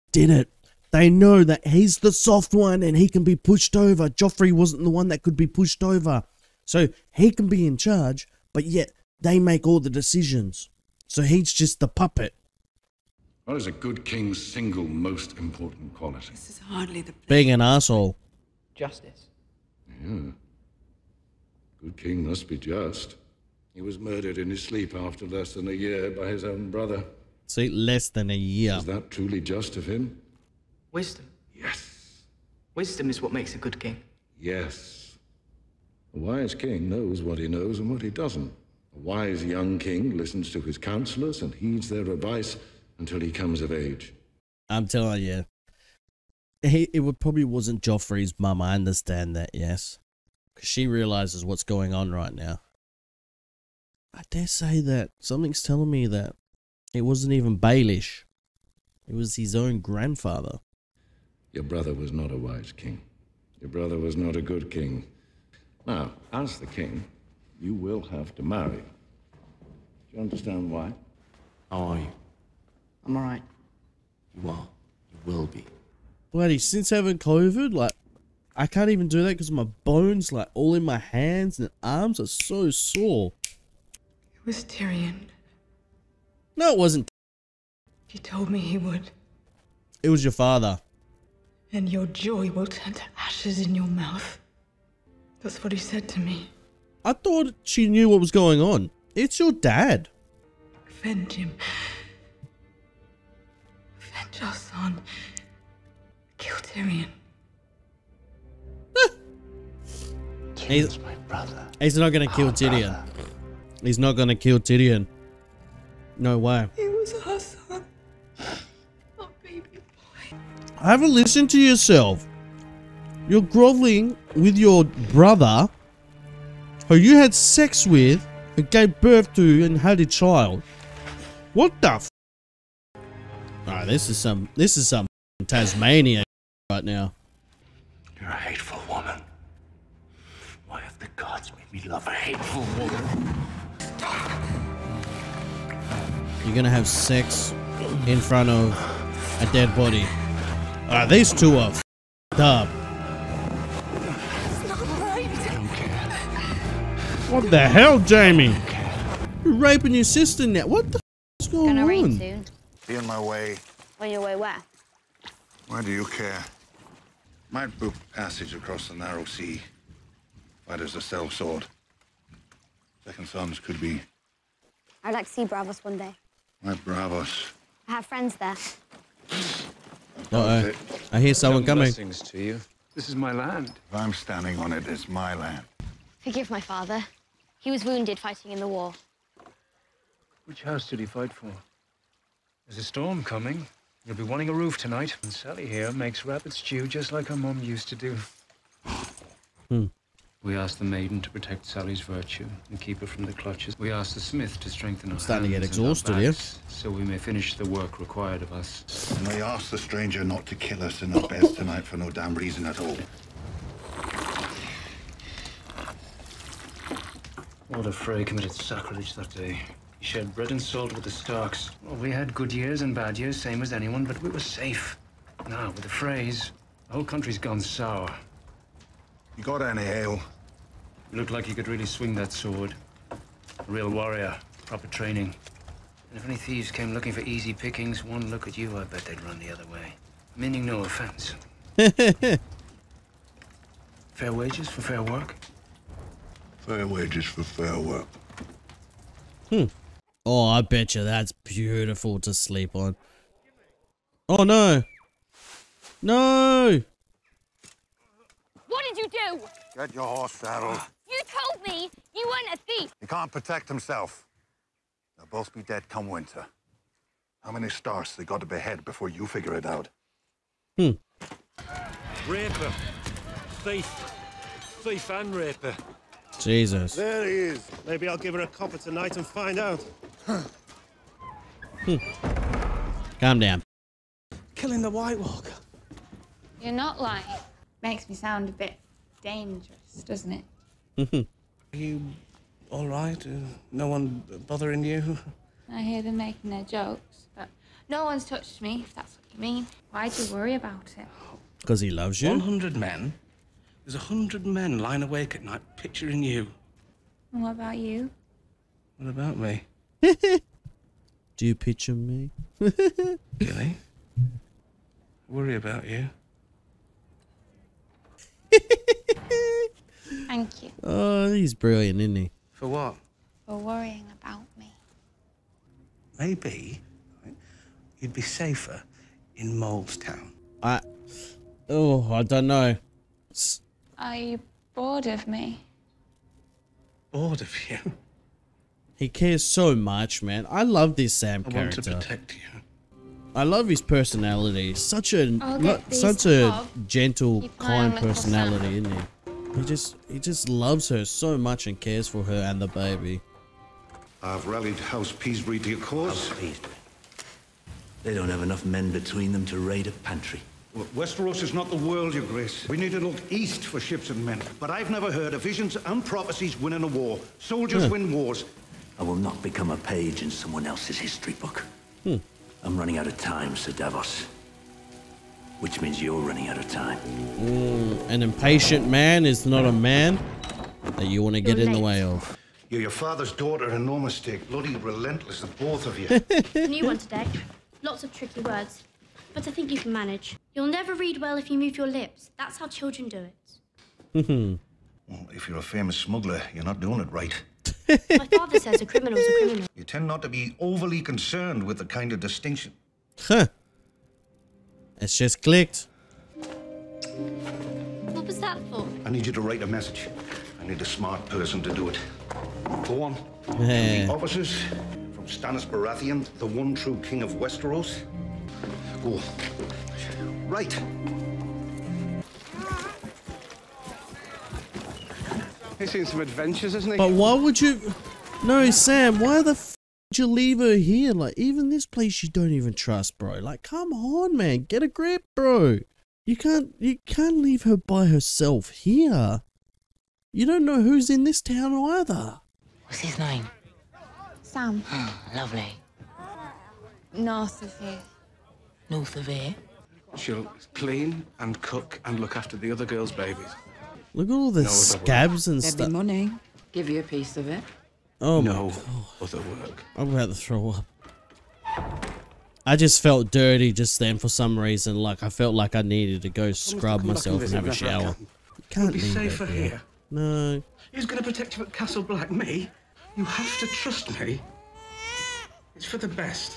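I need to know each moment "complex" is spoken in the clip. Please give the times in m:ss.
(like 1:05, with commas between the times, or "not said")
not said.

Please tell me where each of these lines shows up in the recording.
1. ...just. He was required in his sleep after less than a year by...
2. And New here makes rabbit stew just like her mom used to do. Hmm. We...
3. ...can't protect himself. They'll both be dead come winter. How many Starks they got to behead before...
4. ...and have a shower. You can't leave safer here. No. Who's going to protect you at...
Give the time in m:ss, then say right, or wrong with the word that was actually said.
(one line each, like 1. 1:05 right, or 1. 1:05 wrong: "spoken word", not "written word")
1. 0:22 wrong: "murdered", not "required"
2. 3:15 wrong: "Sally", not "New"
3. 4:23 right
4. 7:47 right.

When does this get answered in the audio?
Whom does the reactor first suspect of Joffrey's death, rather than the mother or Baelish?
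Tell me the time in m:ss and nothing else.
0:59.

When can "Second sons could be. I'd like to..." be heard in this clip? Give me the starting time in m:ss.
2:53.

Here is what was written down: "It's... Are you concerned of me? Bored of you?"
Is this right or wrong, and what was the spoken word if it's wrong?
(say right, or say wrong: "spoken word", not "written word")
wrong: "bored", not "concerned".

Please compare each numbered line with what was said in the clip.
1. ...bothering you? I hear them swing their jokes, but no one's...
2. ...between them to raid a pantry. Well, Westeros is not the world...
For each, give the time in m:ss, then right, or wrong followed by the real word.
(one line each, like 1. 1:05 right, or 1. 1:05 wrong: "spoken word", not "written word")
1. 4:54 wrong: "making", not "swing"
2. 5:58 right.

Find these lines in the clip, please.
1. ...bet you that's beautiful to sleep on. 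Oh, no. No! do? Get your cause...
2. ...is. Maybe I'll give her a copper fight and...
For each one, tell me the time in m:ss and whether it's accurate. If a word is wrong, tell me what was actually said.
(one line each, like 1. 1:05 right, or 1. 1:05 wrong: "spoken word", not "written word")
1. 4:10 wrong: "horse", not "cause"
2. 4:37 wrong: "tonight", not "fight".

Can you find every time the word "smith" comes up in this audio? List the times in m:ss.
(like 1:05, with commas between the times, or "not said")
3:24.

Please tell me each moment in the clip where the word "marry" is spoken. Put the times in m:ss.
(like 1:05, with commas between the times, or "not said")
1:08.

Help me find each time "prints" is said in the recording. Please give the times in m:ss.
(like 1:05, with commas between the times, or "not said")
not said.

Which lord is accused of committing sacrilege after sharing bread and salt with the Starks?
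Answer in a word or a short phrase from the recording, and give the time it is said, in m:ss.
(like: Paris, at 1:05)
Lord Frey, at 3:37.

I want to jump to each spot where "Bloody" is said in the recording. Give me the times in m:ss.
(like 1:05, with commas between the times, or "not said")
1:16, 6:24.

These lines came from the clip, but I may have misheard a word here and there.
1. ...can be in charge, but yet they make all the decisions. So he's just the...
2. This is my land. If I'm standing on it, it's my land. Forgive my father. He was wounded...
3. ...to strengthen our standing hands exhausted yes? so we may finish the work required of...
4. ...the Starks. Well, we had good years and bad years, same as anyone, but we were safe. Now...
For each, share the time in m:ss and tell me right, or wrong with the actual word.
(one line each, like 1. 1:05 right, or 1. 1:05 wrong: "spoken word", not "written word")
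1. 0:07 right
2. 3:02 right
3. 3:24 right
4. 3:41 right.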